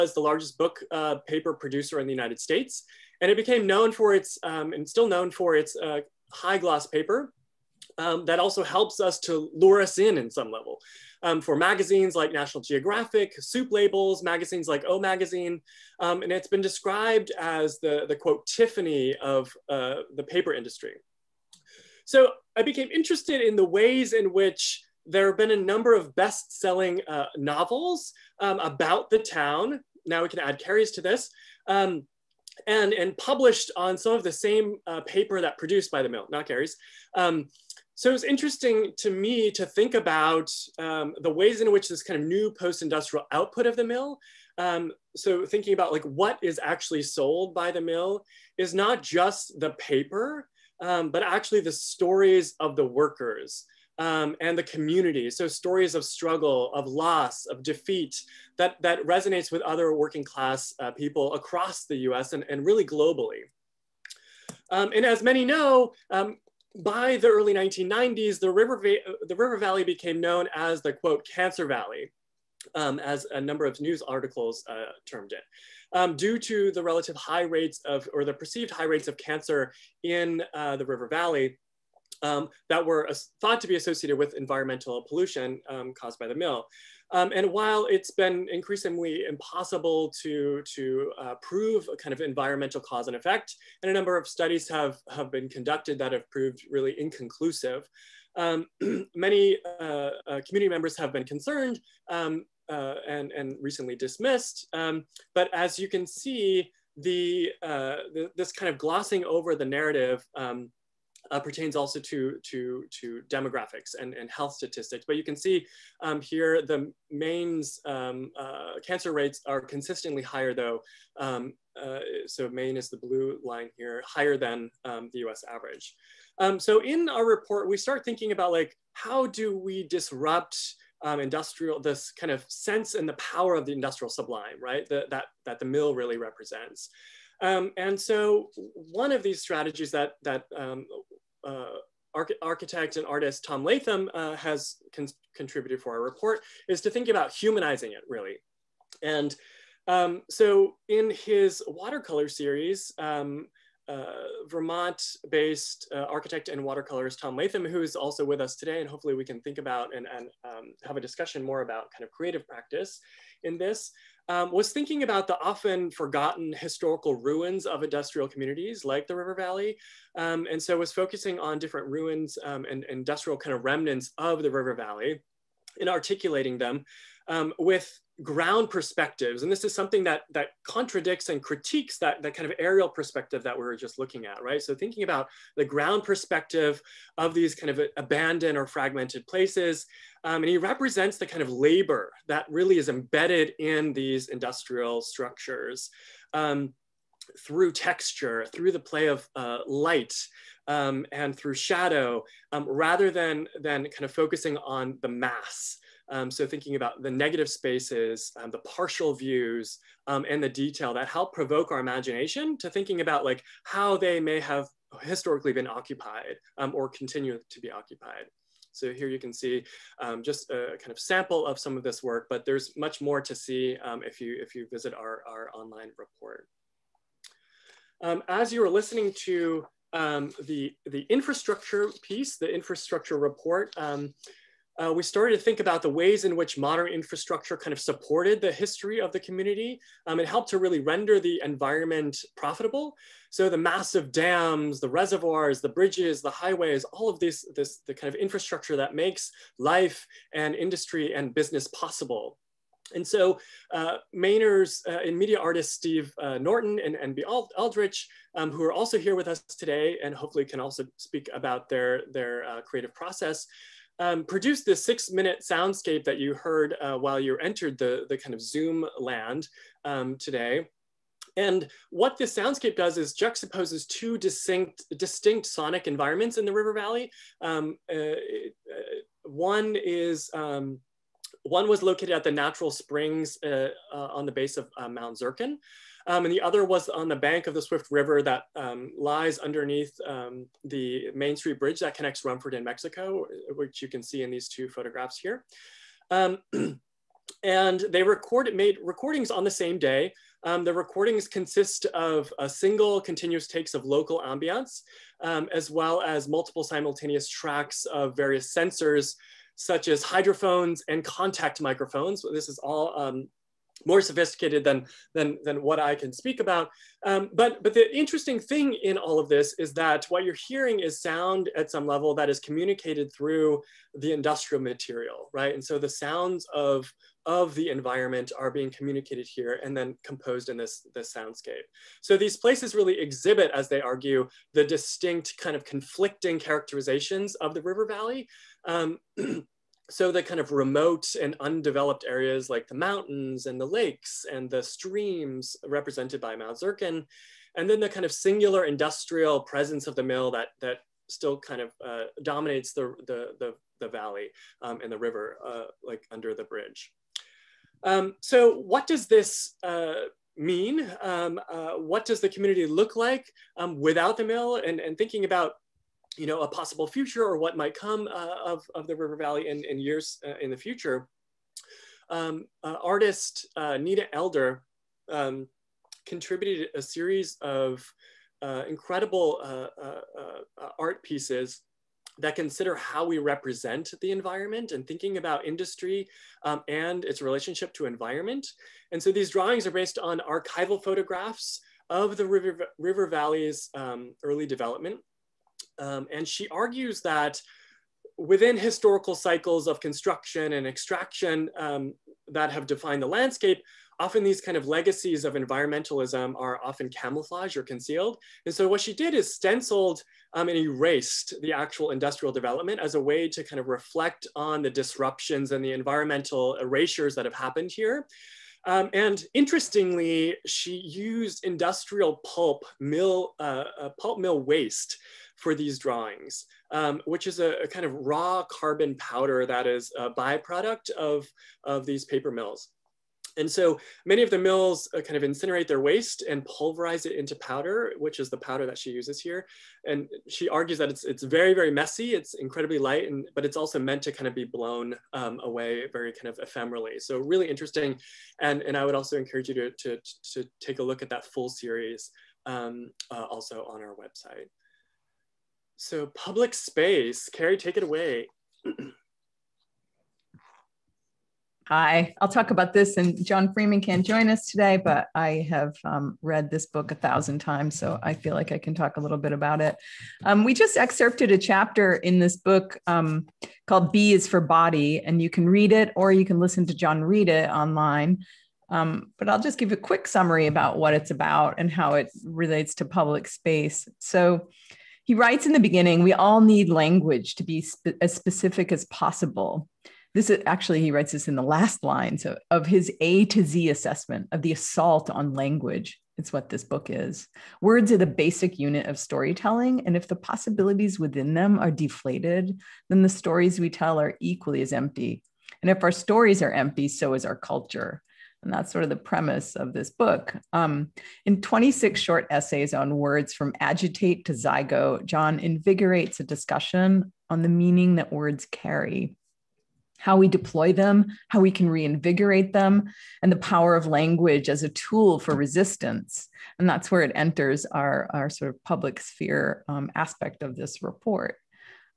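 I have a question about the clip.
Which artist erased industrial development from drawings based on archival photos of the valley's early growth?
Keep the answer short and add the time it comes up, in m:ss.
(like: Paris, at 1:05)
Nita Elder, at 6:13.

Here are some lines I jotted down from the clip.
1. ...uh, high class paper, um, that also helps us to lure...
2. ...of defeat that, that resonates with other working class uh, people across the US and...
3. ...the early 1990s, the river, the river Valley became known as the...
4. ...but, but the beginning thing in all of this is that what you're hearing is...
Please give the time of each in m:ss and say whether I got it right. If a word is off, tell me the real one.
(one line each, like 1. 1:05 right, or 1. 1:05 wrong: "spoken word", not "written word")
1. 0:05 wrong: "gloss", not "class"
2. 0:57 right
3. 1:07 right
4. 5:17 wrong: "interesting", not "beginning".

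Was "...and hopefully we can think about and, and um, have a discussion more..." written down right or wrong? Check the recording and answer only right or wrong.
right.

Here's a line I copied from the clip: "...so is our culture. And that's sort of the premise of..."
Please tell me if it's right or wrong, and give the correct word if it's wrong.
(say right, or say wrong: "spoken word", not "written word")
right.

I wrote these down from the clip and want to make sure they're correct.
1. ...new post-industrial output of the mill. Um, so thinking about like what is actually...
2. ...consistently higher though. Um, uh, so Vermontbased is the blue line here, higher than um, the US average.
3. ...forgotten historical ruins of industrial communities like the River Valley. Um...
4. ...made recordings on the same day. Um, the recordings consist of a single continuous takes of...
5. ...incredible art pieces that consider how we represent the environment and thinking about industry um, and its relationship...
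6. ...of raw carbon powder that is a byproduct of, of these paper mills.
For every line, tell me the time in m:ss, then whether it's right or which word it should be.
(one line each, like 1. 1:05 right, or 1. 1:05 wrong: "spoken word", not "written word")
1. 0:42 right
2. 1:59 wrong: "Maine", not "Vermontbased"
3. 2:45 right
4. 4:58 right
5. 6:18 right
6. 7:07 right.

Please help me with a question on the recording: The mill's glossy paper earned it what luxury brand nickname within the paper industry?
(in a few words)
Tiffany.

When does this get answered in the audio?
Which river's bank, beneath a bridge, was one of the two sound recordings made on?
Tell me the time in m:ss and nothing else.
4:47.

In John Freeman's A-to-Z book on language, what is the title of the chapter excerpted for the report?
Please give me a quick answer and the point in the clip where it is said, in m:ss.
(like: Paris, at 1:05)
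B is for Body, at 7:53.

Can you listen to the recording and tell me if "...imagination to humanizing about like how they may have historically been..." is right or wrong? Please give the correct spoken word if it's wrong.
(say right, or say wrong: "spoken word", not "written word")
wrong: "thinking", not "humanizing".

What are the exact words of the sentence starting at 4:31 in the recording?
And what this soundscape does is juxtaposes two distinct, distinct sonic environments in the River Valley.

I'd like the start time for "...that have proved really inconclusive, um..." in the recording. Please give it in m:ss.
1:35.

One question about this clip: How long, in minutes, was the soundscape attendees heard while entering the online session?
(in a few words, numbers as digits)
6 minutes.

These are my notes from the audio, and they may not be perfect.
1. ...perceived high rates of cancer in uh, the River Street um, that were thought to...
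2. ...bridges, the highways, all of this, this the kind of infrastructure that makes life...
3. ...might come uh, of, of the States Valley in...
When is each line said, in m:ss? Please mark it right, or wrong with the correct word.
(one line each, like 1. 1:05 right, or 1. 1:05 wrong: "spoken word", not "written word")
1. 1:18 wrong: "Valley", not "Street"
2. 4:05 right
3. 6:07 wrong: "River", not "States".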